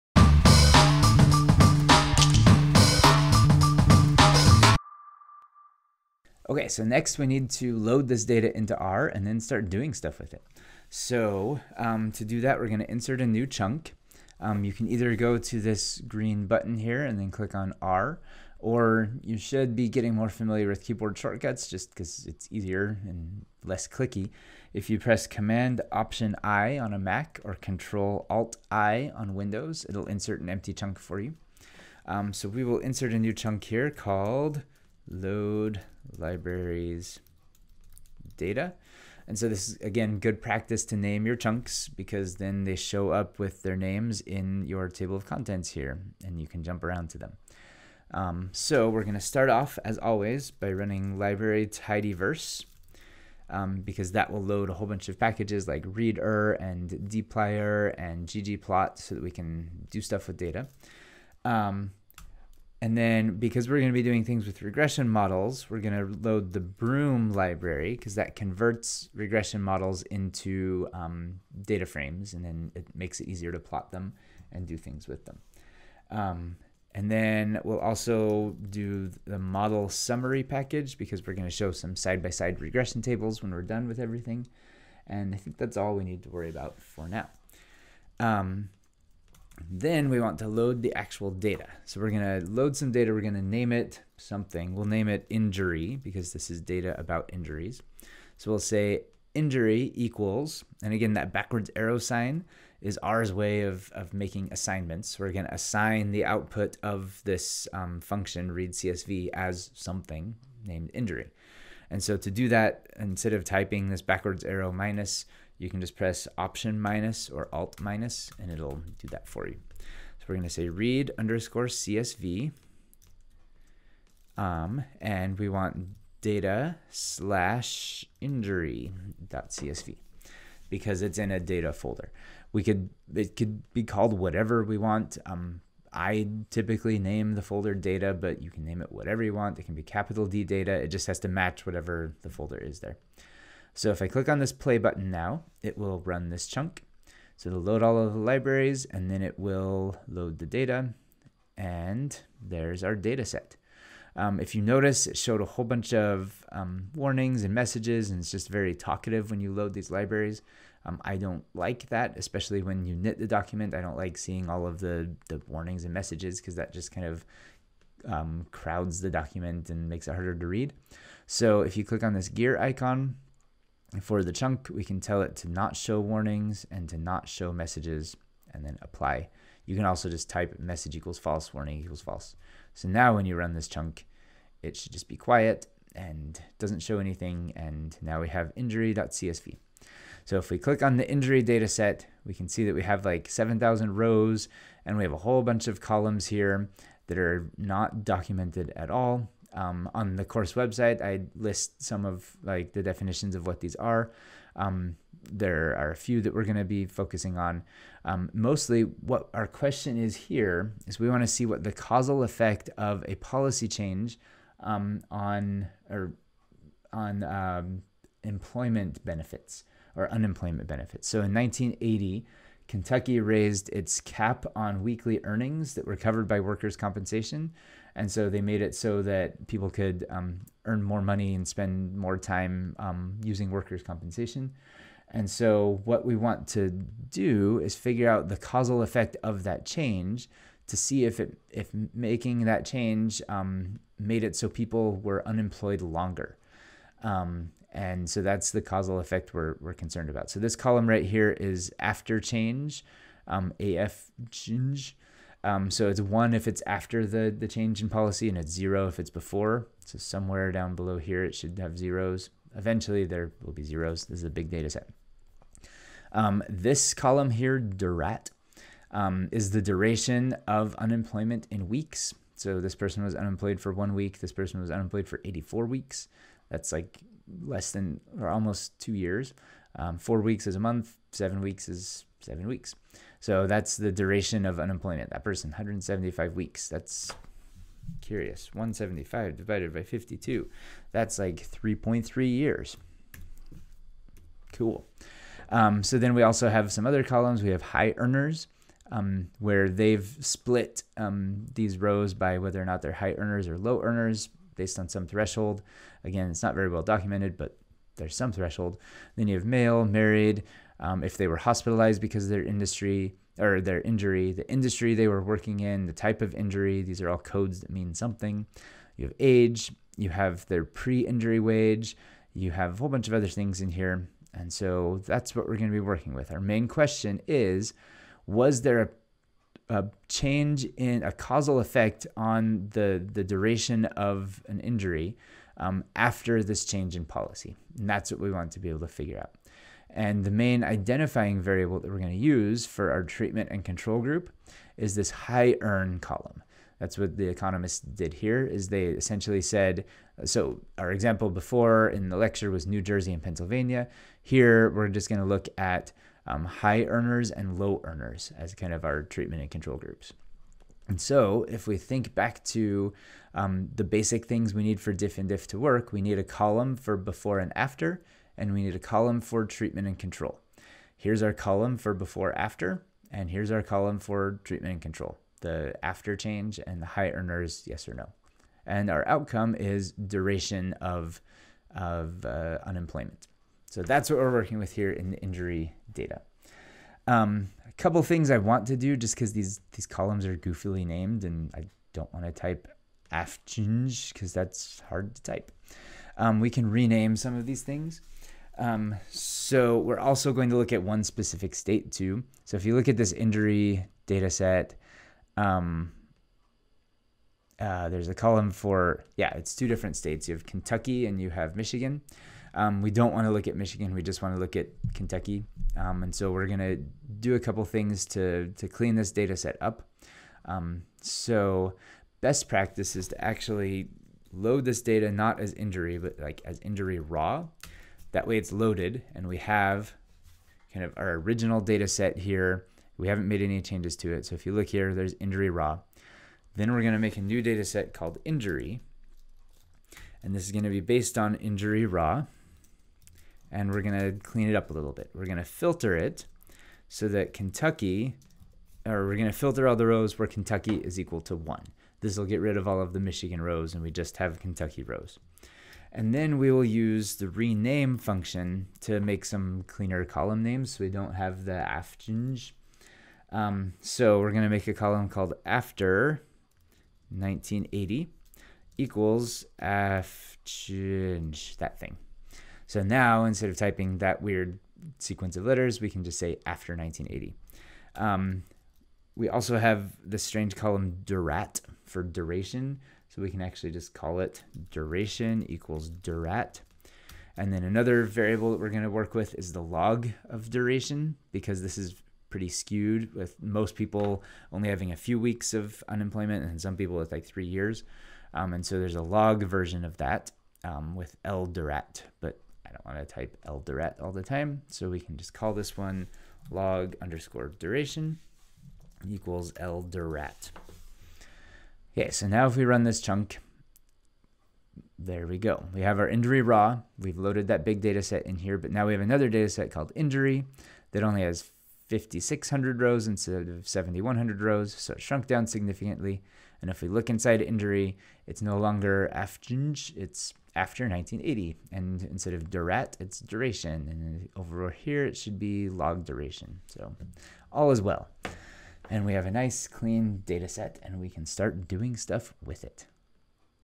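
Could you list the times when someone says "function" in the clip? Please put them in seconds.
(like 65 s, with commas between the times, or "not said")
108 s, 457 s.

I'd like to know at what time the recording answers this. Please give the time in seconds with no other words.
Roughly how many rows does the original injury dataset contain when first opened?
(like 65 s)
193 s.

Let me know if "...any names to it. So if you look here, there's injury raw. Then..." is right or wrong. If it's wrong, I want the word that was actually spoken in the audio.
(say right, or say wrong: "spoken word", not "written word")
wrong: "changes", not "names".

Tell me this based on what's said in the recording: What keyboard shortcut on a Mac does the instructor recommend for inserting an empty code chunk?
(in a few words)
Command Option I.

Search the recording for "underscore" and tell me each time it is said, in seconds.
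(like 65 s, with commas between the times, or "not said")
121 s, 507 s.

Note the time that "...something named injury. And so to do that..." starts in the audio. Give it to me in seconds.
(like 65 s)
109 s.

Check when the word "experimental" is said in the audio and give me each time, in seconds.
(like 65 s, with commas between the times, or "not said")
not said.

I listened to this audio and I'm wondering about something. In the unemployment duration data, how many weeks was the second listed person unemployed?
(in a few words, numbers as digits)
84 weeks.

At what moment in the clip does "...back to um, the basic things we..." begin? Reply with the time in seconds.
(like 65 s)
362 s.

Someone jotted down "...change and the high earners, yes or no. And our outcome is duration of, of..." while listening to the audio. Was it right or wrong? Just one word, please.
right.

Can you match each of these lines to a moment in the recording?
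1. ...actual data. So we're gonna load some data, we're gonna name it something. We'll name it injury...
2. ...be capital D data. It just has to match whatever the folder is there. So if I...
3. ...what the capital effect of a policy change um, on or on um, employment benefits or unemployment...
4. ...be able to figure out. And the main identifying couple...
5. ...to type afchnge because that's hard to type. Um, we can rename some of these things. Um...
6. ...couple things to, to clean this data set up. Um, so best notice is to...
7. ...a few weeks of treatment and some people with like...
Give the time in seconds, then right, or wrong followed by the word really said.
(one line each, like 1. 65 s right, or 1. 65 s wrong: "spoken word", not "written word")
1. 90 s right
2. 139 s right
3. 211 s wrong: "causal", not "capital"
4. 338 s wrong: "variable", not "couple"
5. 392 s right
6. 417 s wrong: "practice", not "notice"
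7. 494 s wrong: "unemployment", not "treatment".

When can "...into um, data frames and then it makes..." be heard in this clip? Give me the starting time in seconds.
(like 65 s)
70 s.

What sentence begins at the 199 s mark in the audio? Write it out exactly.
Um, on the course website, I list some of like the definitions of what these are.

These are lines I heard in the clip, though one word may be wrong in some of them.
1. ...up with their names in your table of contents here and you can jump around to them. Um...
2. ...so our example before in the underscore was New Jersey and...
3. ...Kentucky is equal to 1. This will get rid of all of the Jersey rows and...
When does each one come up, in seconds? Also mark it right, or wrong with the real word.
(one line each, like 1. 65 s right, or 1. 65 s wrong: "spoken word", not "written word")
1. 43 s right
2. 350 s wrong: "lecture", not "underscore"
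3. 450 s wrong: "Michigan", not "Jersey".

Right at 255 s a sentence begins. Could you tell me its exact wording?
Um, so it's one if it's after the, the change in policy, and it's zero if it's before.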